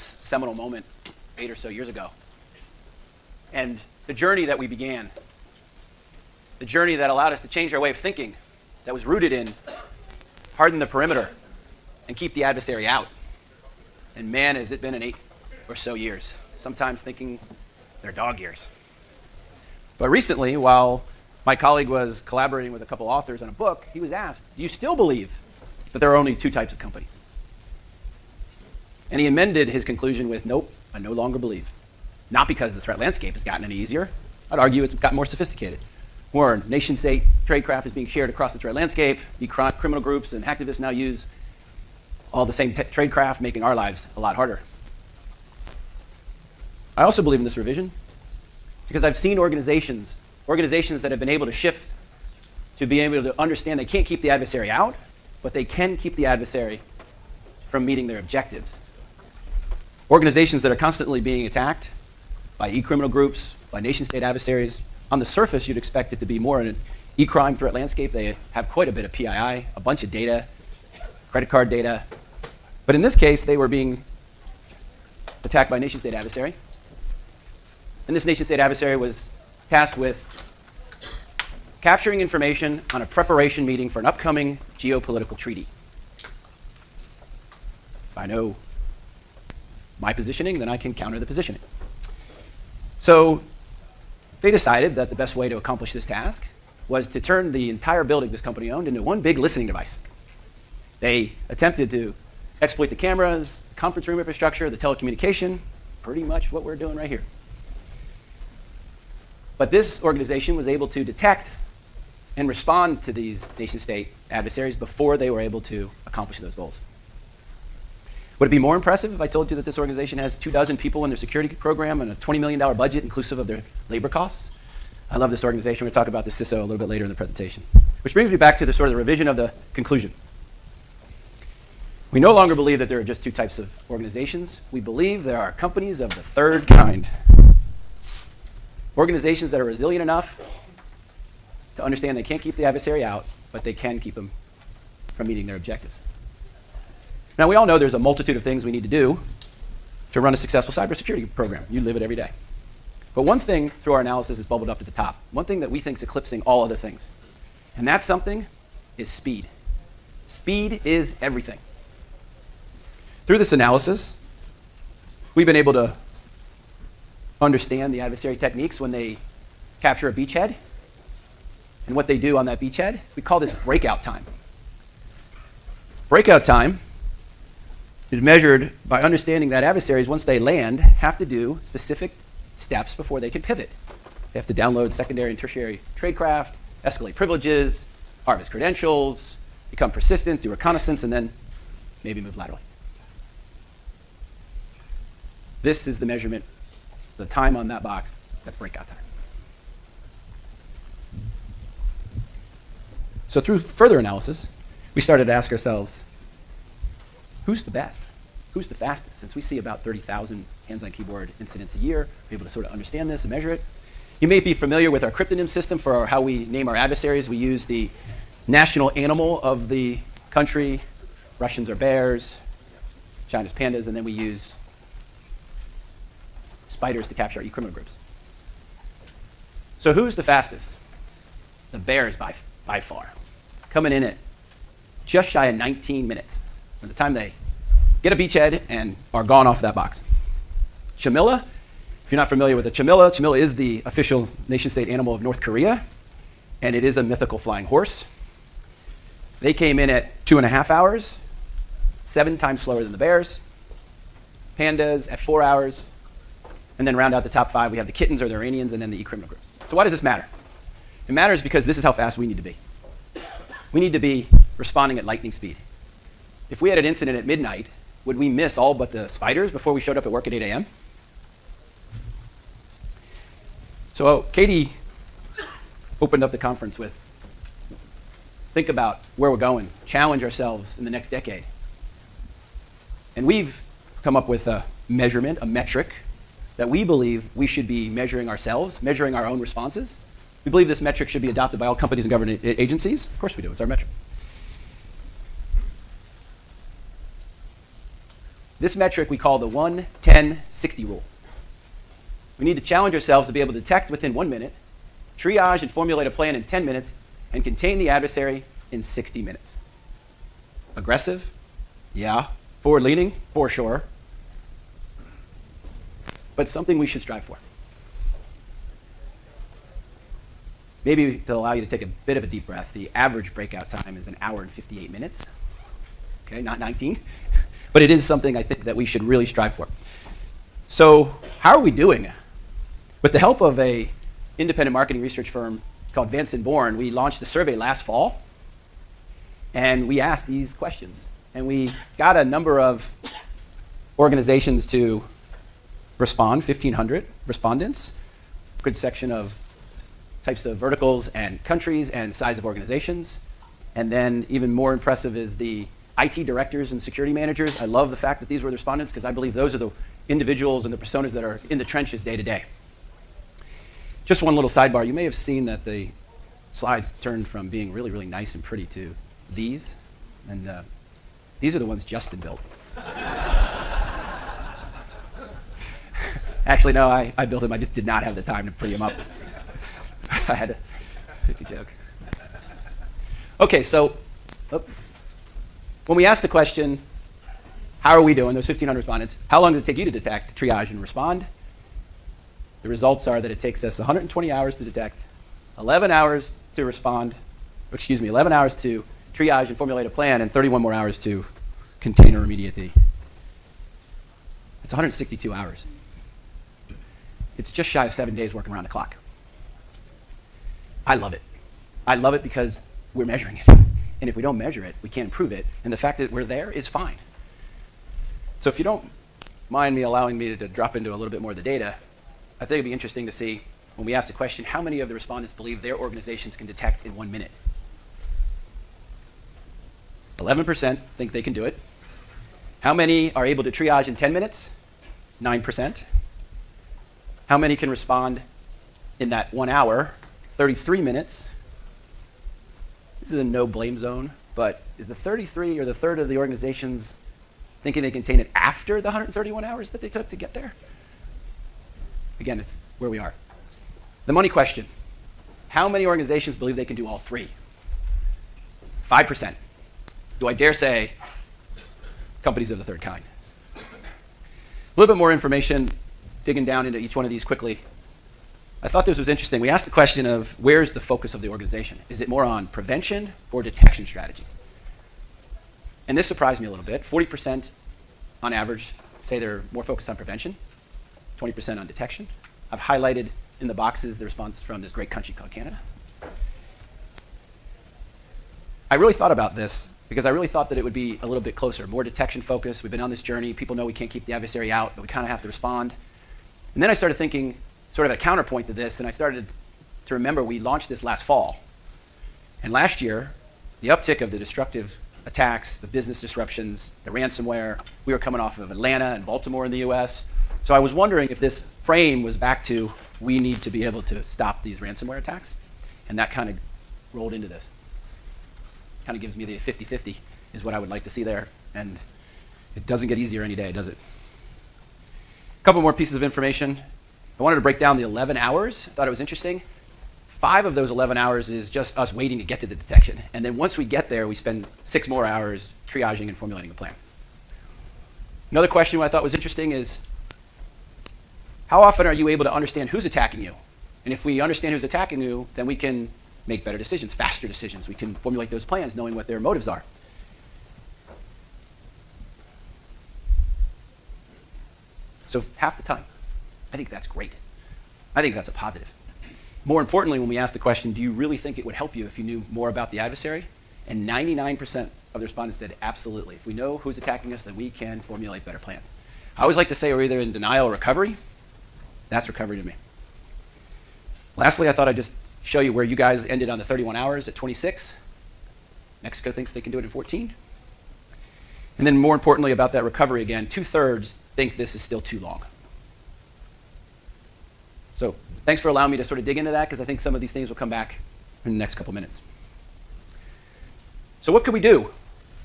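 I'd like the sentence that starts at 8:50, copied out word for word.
Five of those 11 hours is just us waiting to get to the detection.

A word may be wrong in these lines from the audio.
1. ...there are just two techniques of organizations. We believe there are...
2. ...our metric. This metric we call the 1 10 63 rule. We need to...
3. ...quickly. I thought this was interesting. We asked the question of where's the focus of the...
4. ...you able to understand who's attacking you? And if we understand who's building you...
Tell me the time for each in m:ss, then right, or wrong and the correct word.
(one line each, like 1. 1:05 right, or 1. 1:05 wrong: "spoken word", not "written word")
1. 2:12 wrong: "types", not "techniques"
2. 4:53 wrong: "60", not "63"
3. 7:47 right
4. 9:01 wrong: "attacking", not "building".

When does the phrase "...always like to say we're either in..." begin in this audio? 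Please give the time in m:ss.
9:29.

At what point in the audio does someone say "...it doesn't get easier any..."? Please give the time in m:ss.
8:42.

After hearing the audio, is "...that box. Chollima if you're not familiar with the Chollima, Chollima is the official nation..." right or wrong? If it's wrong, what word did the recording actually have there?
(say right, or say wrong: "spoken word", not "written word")
right.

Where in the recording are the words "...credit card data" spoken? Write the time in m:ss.
1:11.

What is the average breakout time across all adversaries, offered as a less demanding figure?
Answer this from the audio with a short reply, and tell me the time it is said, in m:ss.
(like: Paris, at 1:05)
1 hour 58 minutes, at 5:24.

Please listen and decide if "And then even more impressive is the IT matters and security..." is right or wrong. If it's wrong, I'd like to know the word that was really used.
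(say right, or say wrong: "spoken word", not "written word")
wrong: "directors", not "matters".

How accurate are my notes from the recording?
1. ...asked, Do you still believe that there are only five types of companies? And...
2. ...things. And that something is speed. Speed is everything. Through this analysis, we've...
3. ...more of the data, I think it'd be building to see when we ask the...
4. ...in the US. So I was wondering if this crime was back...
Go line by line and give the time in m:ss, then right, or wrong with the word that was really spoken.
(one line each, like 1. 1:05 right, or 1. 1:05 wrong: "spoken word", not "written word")
1. 0:24 wrong: "two", not "five"
2. 2:36 right
3. 7:01 wrong: "interesting", not "building"
4. 8:29 wrong: "frame", not "crime".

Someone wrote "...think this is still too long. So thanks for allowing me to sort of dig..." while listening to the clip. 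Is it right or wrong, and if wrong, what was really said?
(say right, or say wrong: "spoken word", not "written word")
right.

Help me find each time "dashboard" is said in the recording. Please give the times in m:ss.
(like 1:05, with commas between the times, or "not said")
not said.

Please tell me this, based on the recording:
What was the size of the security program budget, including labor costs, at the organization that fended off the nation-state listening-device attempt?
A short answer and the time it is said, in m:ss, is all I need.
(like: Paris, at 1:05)
$20 million, at 2:02.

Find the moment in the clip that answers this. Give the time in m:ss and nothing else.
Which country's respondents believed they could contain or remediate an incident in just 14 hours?
9:38.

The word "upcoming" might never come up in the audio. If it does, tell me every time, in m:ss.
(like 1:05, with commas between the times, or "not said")
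1:24.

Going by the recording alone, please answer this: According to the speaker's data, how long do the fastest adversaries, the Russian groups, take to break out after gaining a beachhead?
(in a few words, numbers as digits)
just shy of 19 minutes.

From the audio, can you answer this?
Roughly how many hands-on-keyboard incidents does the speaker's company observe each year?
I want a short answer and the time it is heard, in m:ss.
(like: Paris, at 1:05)
30,000, at 3:29.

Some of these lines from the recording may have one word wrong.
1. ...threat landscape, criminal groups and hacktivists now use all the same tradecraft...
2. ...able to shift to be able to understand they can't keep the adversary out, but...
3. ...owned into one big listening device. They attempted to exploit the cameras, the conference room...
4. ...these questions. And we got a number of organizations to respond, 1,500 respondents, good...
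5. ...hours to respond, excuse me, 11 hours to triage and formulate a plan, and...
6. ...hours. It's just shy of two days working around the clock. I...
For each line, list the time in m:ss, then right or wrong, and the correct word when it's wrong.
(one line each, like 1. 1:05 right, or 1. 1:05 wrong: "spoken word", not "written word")
1. 0:38 right
2. 0:51 right
3. 1:38 right
4. 5:40 right
5. 6:35 right
6. 6:45 wrong: "seven", not "two".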